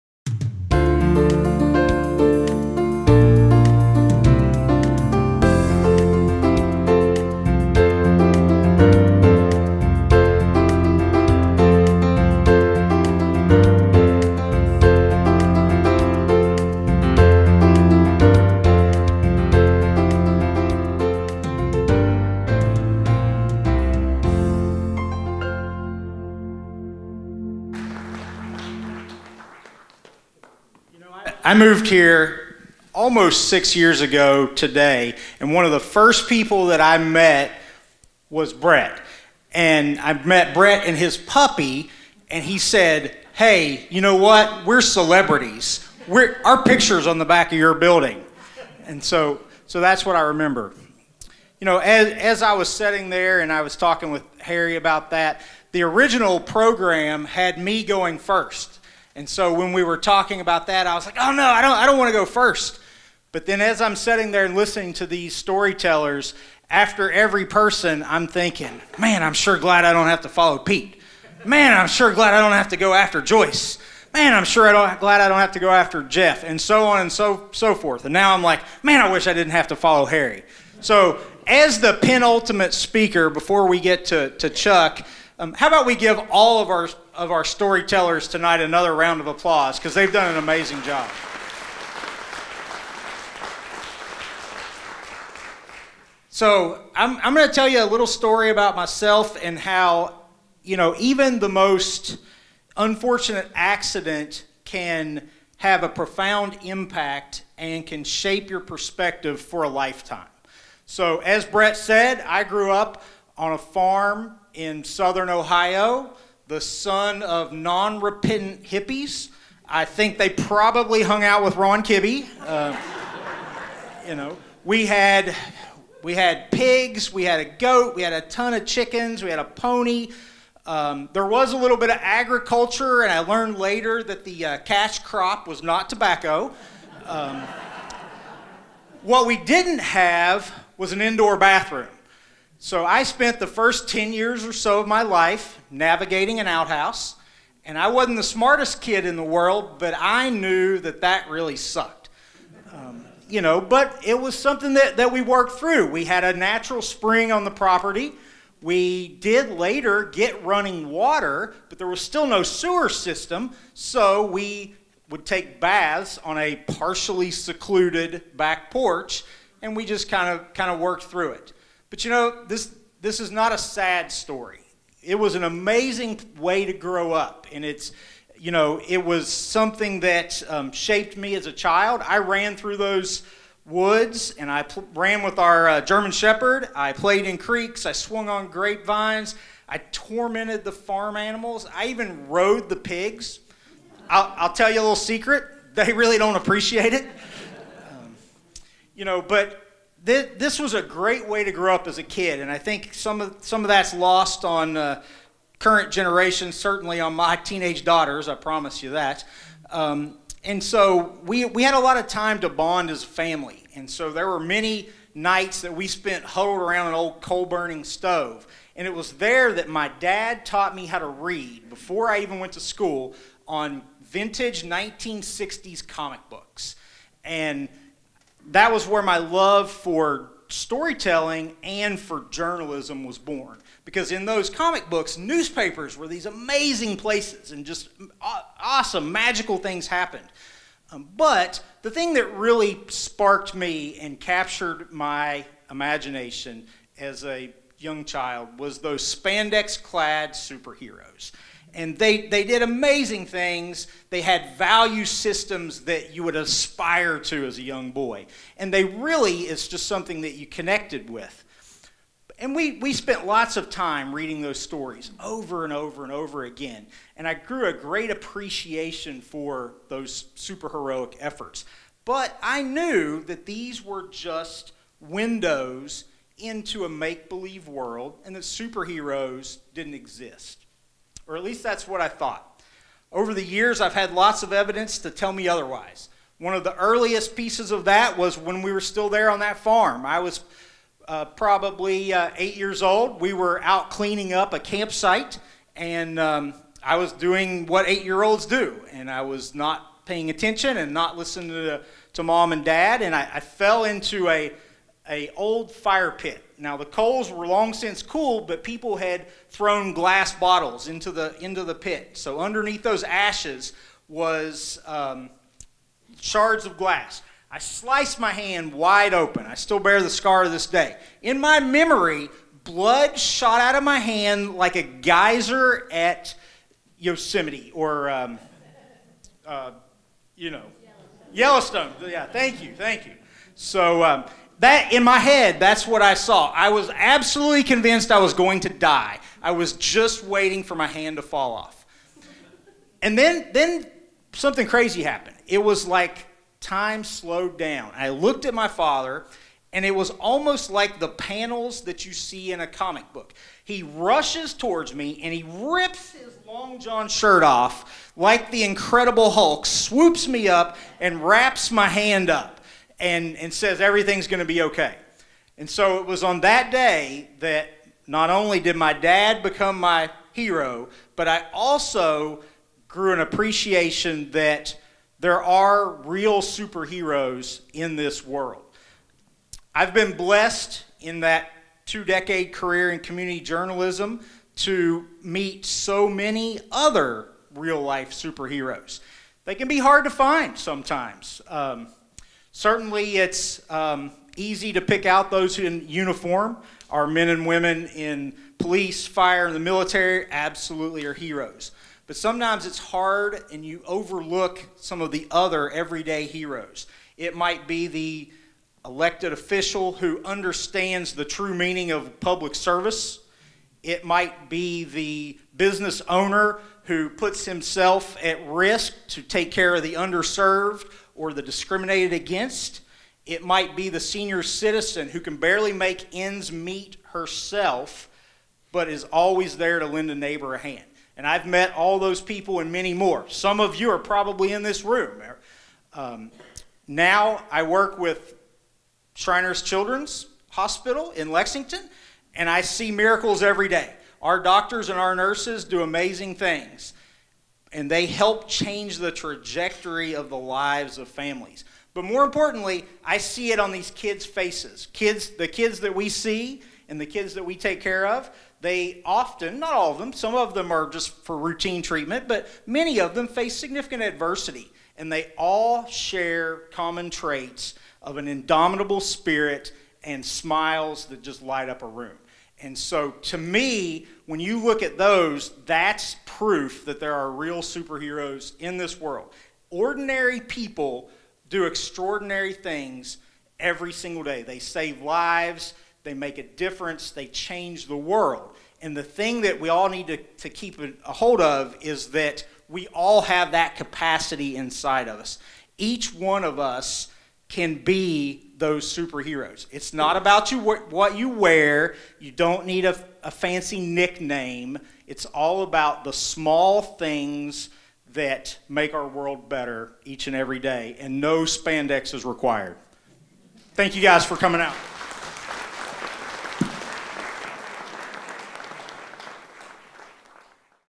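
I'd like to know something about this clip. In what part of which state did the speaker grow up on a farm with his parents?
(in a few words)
Southern Ohio.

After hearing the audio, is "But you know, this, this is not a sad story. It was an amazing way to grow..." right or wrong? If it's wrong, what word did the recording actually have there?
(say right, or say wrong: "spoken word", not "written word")
right.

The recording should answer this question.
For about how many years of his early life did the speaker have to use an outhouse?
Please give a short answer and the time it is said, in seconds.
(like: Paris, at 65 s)
10, at 143 s.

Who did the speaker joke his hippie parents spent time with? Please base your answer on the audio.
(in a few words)
Ron Kibbe.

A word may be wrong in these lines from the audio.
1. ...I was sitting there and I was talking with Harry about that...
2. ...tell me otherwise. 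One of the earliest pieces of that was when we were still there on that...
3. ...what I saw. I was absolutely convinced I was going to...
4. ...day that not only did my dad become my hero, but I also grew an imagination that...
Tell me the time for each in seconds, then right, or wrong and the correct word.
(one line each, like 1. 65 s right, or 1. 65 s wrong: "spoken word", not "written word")
1. 52 s right
2. 285 s right
3. 335 s right
4. 366 s wrong: "appreciation", not "imagination".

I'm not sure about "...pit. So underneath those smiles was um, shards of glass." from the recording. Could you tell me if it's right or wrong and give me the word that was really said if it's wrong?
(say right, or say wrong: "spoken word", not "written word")
wrong: "ashes", not "smiles".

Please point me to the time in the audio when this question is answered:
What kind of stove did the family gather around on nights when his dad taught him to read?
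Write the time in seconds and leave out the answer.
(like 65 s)
217 s.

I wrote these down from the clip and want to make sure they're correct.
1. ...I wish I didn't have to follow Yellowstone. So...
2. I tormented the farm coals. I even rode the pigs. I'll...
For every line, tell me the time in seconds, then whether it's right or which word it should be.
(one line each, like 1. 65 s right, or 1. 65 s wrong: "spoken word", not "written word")
1. 79 s wrong: "Harry", not "Yellowstone"
2. 189 s wrong: "animals", not "coals".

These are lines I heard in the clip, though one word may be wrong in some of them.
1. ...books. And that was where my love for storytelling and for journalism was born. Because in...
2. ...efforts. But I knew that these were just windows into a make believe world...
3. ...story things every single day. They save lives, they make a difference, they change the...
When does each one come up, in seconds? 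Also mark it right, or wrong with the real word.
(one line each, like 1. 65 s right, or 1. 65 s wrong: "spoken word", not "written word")
1. 226 s right
2. 271 s right
3. 481 s wrong: "extraordinary", not "story".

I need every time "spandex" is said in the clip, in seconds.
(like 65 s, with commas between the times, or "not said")
249 s, 511 s.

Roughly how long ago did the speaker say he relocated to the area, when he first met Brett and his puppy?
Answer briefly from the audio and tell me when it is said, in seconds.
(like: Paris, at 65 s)
6 years, at 33 s.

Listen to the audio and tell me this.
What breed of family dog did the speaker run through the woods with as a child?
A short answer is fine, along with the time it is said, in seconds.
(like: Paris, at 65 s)
German Shepherd, at 185 s.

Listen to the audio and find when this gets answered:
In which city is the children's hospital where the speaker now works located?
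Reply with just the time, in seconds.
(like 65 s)
441 s.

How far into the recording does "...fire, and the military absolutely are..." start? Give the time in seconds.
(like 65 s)
399 s.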